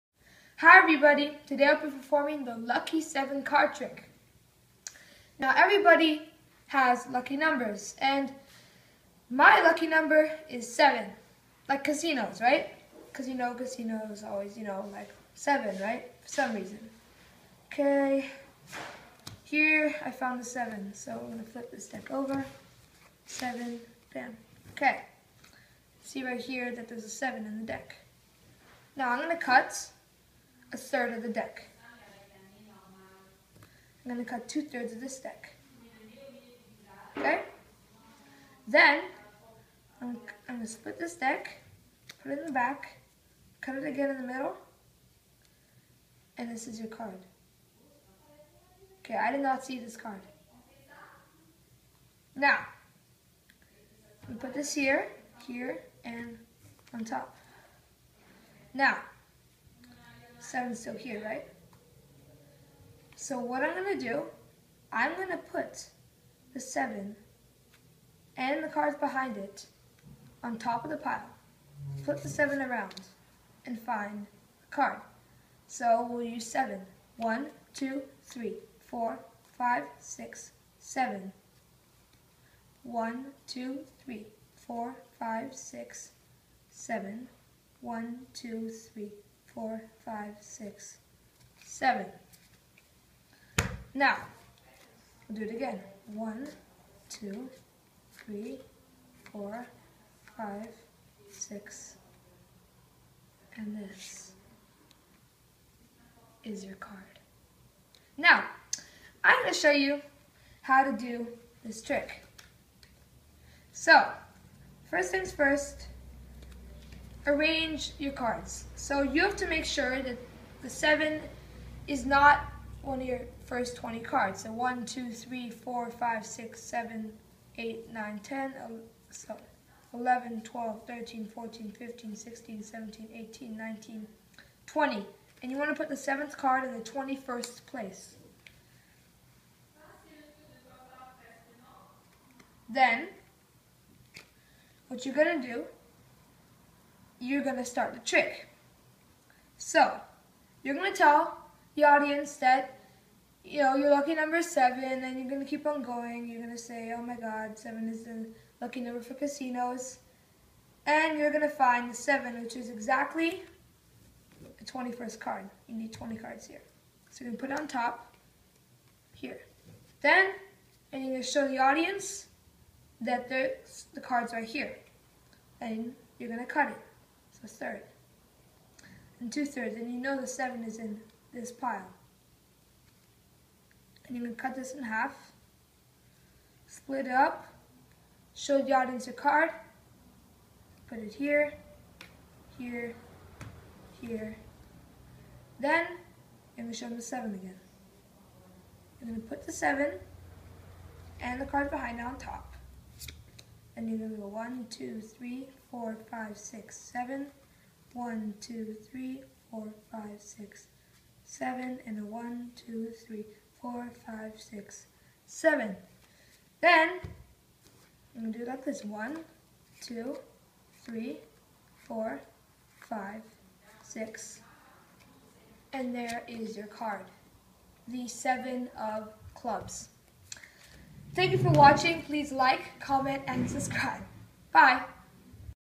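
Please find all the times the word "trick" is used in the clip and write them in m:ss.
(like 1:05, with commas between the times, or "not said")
0:03, 1:51, 2:27.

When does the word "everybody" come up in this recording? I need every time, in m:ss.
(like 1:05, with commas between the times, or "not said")
0:00, 0:05.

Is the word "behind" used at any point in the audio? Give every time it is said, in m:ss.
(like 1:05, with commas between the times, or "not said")
1:08, 3:21.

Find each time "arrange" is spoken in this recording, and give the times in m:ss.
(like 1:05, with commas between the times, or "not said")
1:57.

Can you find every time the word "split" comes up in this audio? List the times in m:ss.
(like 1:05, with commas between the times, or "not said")
0:40, 3:06.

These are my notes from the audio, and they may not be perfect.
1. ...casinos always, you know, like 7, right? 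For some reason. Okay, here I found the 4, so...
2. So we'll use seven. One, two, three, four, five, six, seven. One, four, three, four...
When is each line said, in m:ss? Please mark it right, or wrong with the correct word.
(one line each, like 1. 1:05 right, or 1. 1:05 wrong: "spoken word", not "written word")
1. 0:13 wrong: "7", not "4"
2. 1:15 wrong: "two", not "four".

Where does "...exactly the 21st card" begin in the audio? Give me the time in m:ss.
2:42.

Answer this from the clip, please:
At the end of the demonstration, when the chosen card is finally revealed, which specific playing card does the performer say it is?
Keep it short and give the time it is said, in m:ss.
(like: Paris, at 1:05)
Seven of clubs, at 3:48.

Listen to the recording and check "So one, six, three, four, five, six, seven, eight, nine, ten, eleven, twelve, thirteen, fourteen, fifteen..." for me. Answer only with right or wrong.
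wrong.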